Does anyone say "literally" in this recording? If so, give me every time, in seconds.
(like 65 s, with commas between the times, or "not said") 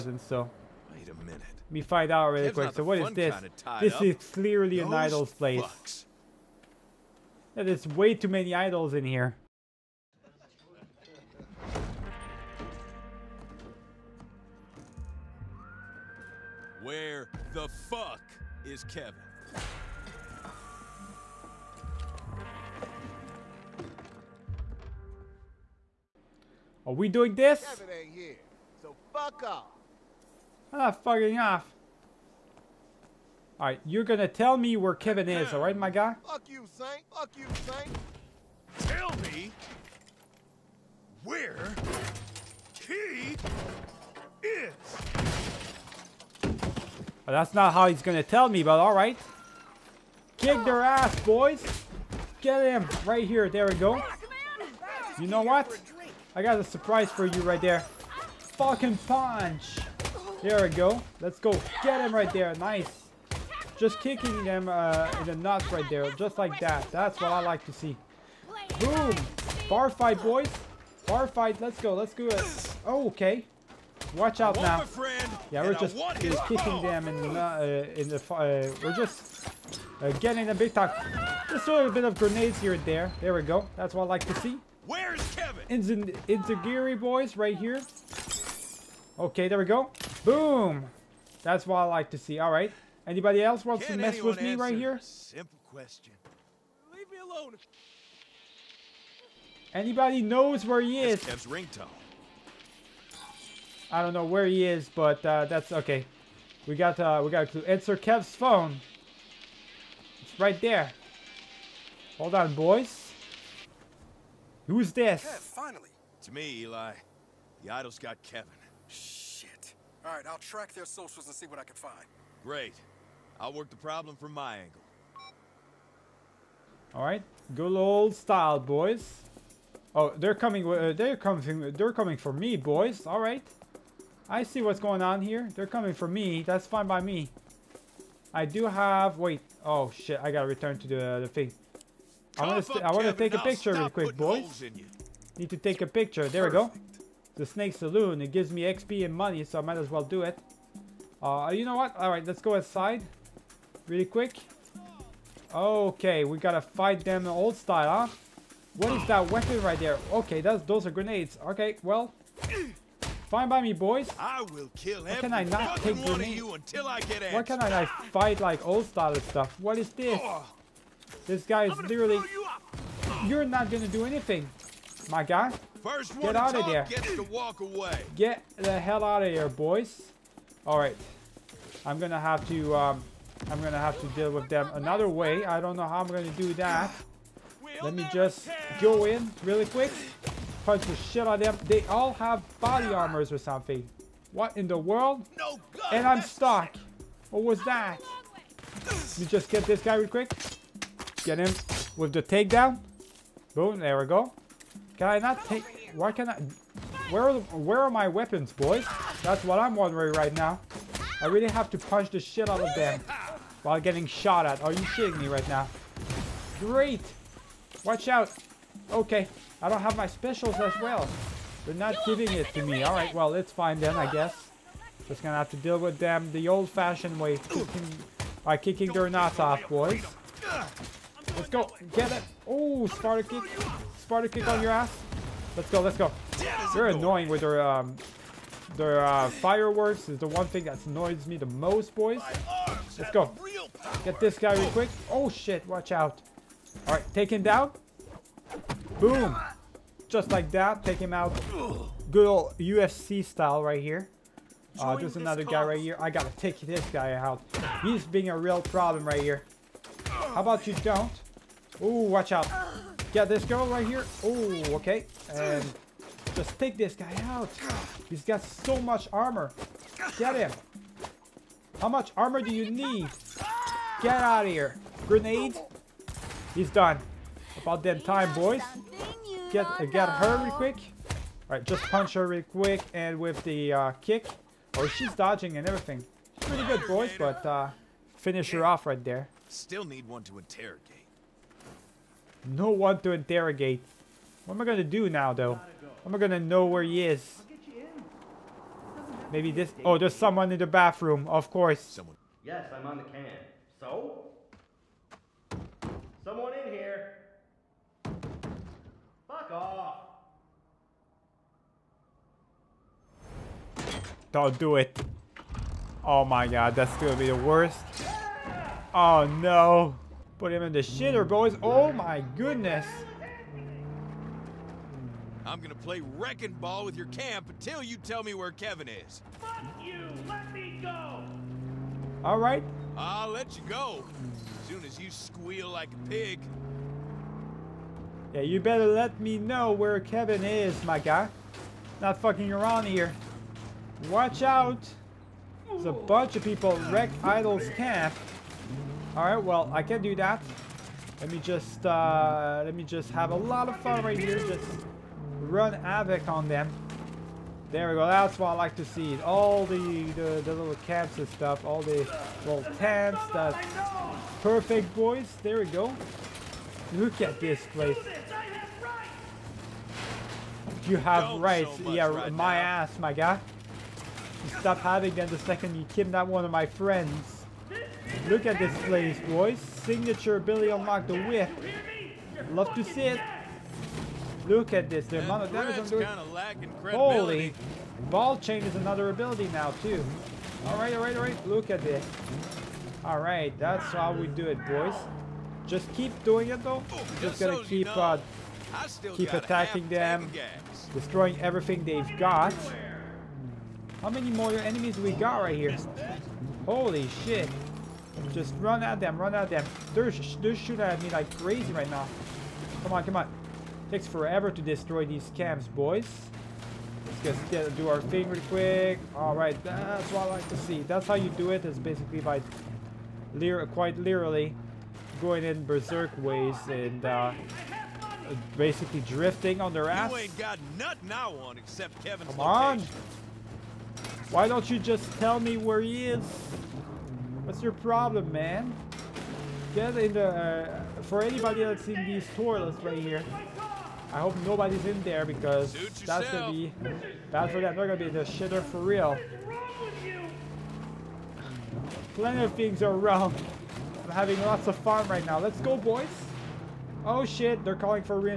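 171 s, 423 s.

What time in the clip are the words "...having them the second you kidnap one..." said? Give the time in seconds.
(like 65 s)
374 s.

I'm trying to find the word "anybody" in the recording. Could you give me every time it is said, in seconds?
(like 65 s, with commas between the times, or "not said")
93 s, 99 s, 441 s.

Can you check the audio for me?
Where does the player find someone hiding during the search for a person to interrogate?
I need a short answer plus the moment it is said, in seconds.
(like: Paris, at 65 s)
bathroom, at 300 s.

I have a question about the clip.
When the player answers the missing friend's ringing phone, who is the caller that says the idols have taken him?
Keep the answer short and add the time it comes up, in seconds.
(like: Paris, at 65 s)
Eli, at 116 s.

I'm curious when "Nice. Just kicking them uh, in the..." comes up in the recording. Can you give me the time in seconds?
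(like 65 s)
62 s.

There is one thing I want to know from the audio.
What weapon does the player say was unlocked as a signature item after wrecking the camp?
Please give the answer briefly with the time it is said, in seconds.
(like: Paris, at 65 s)
the whip, at 381 s.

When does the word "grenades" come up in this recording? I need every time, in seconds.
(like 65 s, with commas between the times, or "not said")
82 s, 160 s, 166 s, 275 s.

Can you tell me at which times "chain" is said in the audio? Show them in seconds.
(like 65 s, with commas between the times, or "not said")
388 s.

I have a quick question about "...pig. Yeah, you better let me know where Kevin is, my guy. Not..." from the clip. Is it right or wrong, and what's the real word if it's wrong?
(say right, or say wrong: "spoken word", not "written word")
right.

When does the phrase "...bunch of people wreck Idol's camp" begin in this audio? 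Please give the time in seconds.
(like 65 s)
345 s.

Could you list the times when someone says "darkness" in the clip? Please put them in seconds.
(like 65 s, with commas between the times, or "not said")
not said.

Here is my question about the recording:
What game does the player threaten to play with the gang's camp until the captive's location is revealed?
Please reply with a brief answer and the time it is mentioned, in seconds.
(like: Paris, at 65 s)
wrecking ball, at 326 s.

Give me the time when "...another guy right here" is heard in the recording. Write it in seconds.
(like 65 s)
255 s.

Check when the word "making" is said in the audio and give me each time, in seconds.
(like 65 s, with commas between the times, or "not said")
not said.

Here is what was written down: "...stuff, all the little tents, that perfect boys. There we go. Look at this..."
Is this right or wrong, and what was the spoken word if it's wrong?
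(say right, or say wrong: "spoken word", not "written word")
right.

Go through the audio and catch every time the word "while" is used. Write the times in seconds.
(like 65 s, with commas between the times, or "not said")
213 s.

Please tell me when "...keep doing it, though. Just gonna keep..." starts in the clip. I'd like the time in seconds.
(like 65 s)
395 s.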